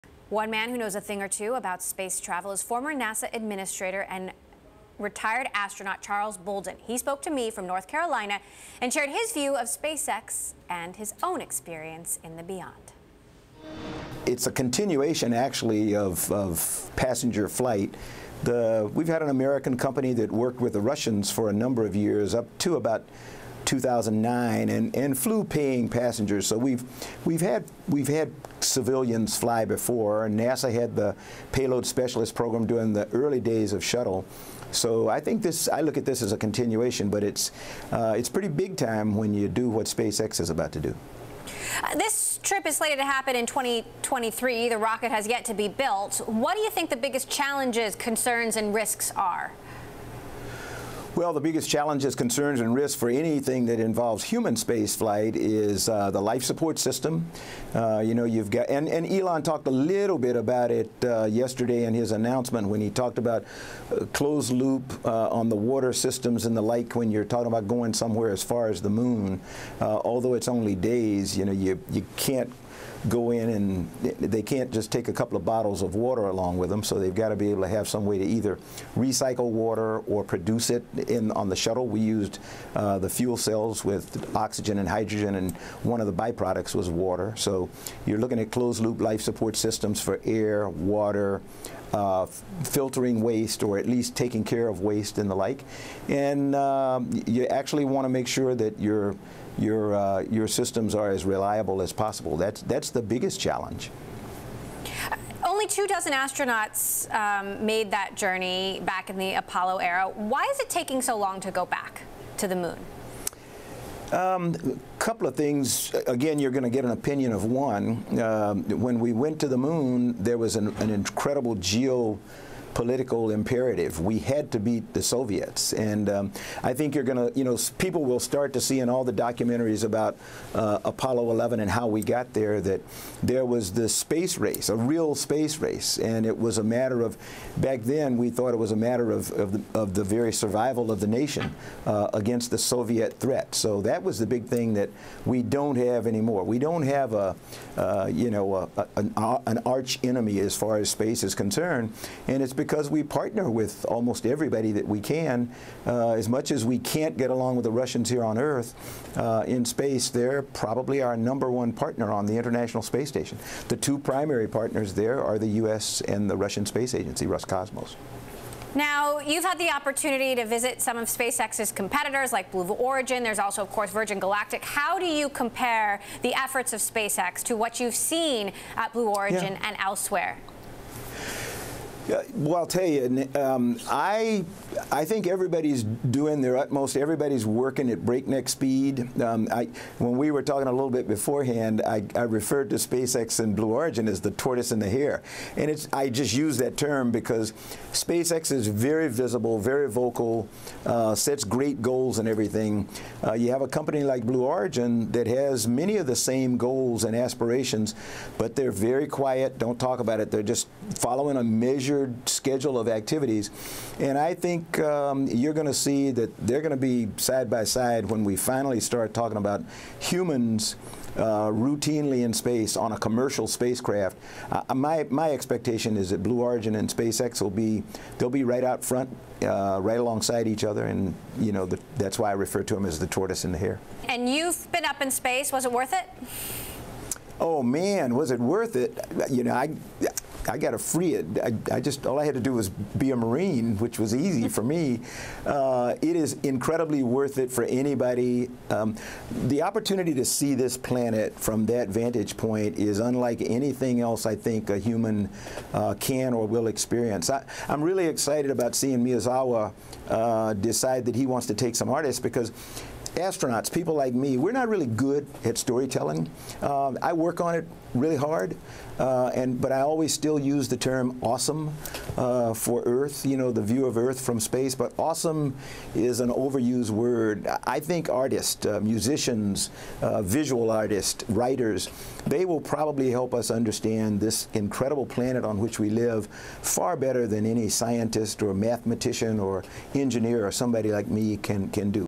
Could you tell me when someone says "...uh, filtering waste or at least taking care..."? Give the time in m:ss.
1:31.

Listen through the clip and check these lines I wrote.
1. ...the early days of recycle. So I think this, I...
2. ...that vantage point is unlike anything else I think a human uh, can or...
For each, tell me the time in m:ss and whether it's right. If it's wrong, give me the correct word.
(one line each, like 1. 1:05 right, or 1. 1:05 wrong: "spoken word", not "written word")
1. 0:32 wrong: "shuttle", not "recycle"
2. 4:11 right.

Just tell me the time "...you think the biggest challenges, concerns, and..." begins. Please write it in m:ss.
0:46.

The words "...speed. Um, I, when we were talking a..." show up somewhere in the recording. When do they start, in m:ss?
3:08.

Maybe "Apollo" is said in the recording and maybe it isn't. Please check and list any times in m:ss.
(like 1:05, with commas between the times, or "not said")
1:49, 2:10.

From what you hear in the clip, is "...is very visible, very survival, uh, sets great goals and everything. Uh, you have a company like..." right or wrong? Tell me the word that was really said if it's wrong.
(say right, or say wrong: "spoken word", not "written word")
wrong: "vocal", not "survival".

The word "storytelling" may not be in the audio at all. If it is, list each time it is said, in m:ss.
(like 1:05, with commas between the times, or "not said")
4:25.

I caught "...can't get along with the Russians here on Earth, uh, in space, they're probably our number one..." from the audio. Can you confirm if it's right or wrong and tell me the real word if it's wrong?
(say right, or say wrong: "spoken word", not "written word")
right.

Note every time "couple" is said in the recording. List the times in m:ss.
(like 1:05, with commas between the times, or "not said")
1:15, 1:54.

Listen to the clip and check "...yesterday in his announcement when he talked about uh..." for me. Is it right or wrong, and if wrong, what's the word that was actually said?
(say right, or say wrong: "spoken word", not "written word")
right.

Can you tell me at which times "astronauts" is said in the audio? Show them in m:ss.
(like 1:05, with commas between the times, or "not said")
0:05, 1:46, 4:23.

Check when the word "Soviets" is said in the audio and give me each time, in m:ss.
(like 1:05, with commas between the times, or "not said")
2:05, 2:22.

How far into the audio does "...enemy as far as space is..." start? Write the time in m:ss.
2:30.